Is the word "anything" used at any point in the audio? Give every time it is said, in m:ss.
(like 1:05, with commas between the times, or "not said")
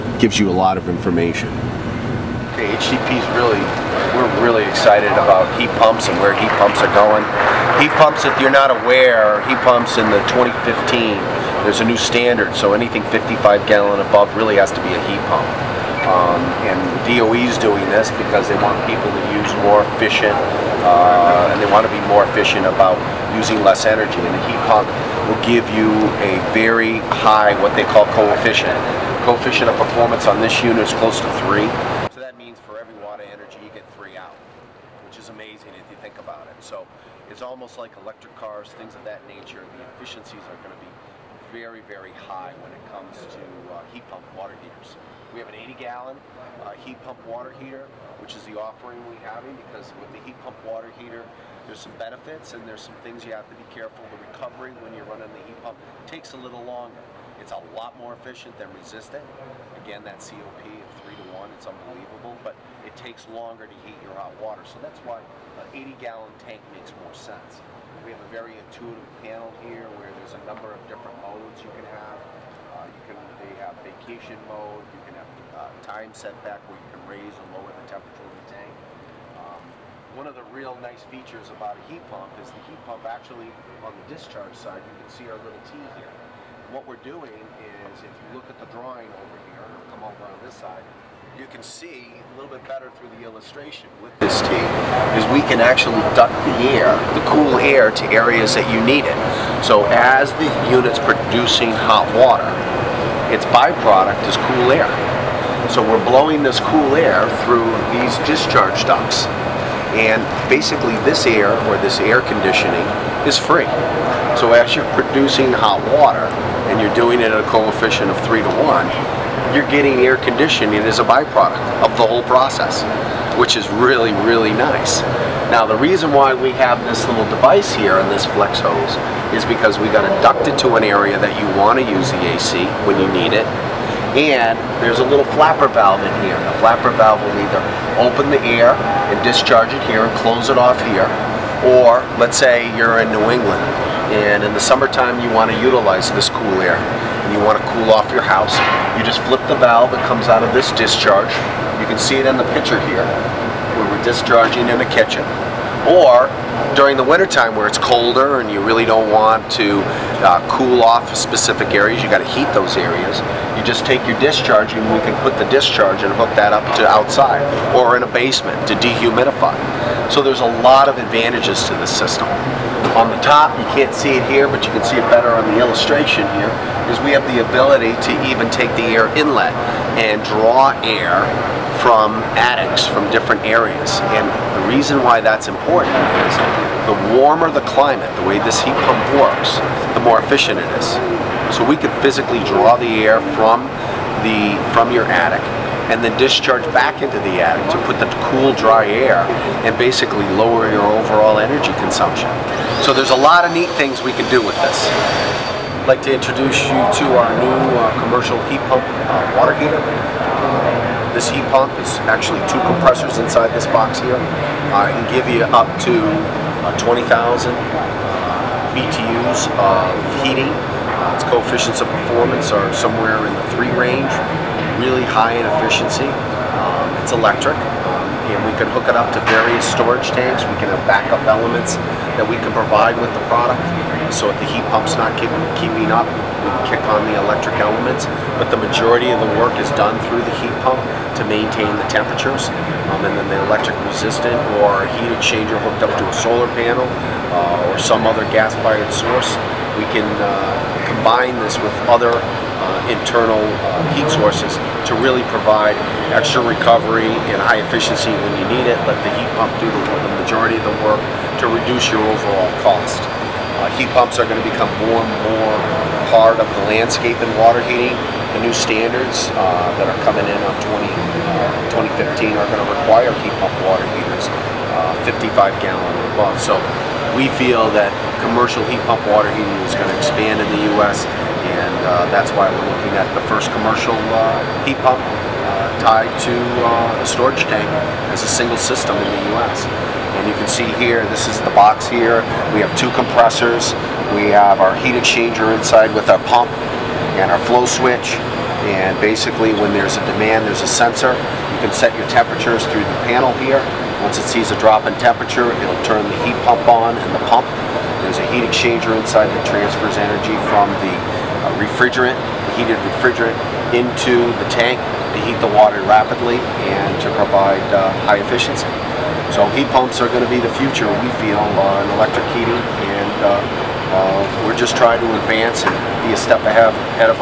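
0:12.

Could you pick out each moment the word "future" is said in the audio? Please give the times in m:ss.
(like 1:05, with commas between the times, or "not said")
5:20.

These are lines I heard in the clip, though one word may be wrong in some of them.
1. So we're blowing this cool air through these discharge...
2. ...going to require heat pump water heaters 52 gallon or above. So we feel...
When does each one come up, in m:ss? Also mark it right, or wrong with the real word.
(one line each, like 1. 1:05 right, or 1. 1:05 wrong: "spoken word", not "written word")
1. 1:45 right
2. 4:32 wrong: "55", not "52".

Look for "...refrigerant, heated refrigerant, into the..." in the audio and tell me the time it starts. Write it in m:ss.
5:11.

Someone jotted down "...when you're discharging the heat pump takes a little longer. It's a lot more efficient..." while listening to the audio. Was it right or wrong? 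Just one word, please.
wrong.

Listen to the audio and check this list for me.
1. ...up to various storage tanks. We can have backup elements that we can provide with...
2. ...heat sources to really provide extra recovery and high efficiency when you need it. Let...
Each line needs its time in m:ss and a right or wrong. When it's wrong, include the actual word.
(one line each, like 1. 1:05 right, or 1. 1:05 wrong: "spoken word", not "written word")
1. 3:48 right
2. 4:13 right.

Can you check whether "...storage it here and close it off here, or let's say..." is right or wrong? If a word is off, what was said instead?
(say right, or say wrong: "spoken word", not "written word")
wrong: "discharge", not "storage".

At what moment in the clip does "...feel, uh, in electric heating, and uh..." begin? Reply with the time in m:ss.
5:21.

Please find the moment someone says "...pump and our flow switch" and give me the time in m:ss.
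4:56.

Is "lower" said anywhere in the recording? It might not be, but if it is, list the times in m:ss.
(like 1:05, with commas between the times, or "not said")
1:17, 3:20.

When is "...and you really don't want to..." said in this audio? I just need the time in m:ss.
2:38.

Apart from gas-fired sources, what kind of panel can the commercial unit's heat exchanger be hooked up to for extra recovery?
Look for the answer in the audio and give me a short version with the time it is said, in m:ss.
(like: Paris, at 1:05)
solar panel, at 4:06.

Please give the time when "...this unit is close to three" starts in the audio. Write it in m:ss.
0:30.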